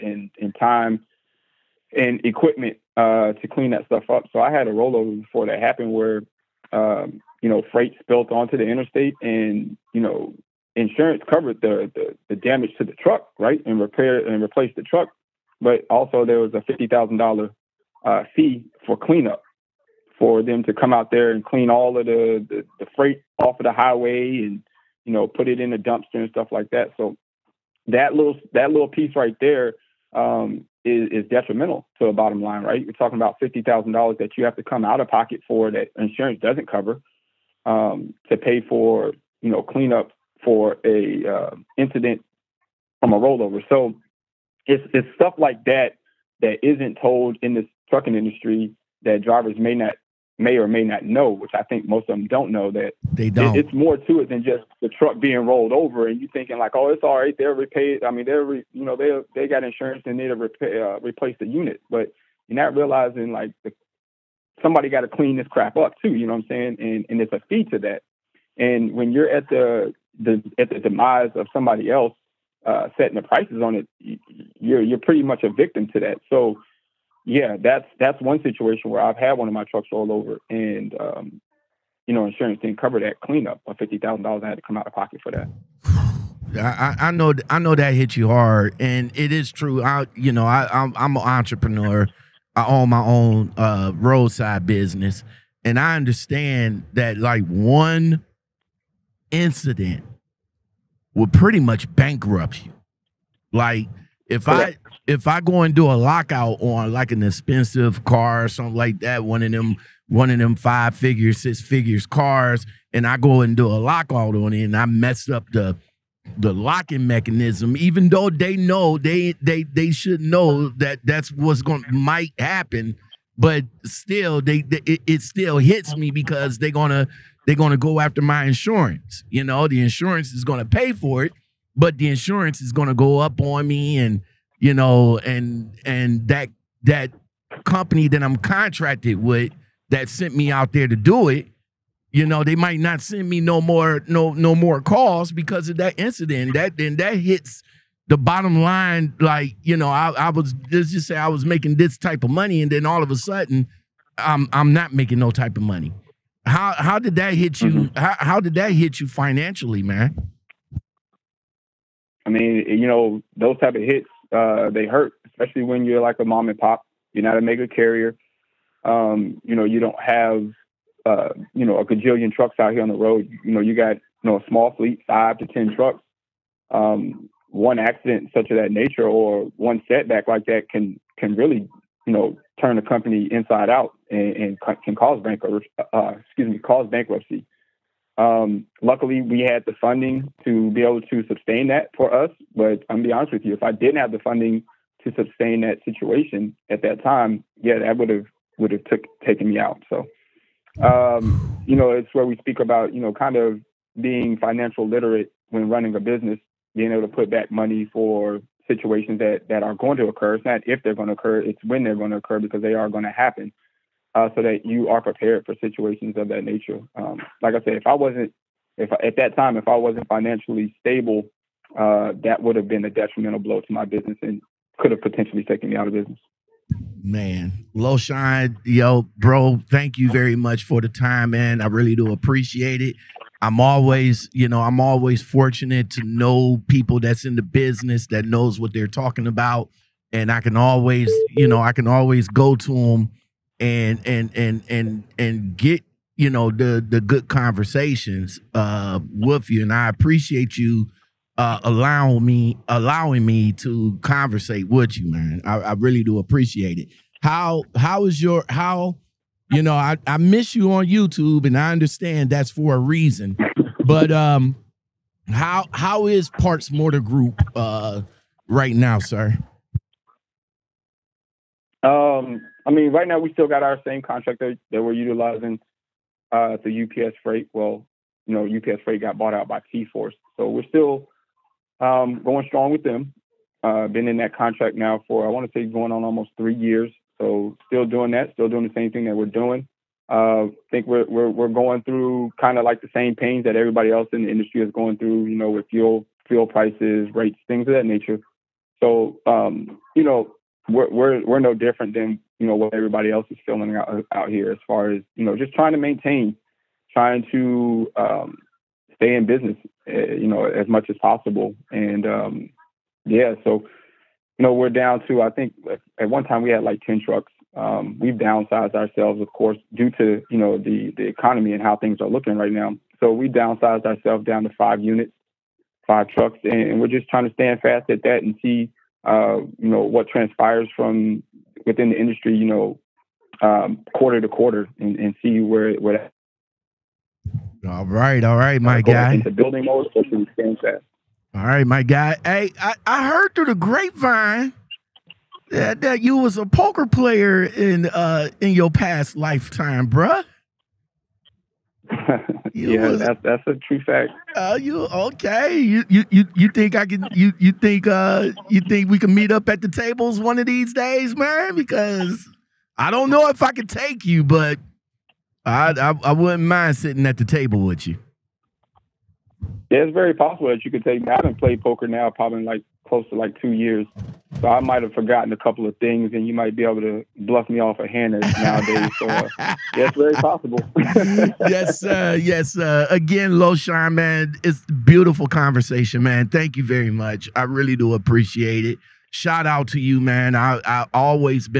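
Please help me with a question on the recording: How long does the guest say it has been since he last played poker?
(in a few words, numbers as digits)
2 years.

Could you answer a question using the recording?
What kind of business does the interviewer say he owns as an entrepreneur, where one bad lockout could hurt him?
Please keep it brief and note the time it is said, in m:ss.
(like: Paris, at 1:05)
roadside business, at 1:33.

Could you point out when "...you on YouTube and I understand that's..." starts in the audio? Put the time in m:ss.
4:20.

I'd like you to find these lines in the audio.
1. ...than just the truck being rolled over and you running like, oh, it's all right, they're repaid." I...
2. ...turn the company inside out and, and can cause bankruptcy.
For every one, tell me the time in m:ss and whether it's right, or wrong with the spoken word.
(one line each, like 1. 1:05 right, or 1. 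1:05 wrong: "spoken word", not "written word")
1. 0:54 wrong: "thinking", not "running"
2. 3:02 right.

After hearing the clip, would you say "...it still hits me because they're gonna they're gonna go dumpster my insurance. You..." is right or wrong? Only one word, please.
wrong.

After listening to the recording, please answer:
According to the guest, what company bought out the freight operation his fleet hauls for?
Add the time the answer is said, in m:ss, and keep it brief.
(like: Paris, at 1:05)
T-Force, at 4:39.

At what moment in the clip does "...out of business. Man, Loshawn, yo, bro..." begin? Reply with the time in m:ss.
3:45.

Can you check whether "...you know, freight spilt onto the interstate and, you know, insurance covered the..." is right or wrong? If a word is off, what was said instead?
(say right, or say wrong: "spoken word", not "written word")
right.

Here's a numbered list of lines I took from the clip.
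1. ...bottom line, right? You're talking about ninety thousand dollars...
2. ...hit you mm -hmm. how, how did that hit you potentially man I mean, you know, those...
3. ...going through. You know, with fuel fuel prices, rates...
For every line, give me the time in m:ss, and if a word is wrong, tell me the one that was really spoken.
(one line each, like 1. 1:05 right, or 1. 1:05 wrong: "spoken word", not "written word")
1. 0:32 wrong: "fifty", not "ninety"
2. 2:37 wrong: "financially", not "potentially"
3. 4:54 right.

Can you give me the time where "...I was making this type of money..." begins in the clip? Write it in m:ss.
2:31.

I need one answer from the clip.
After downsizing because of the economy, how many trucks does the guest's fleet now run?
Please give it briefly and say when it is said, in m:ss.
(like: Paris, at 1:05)
5, at 5:24.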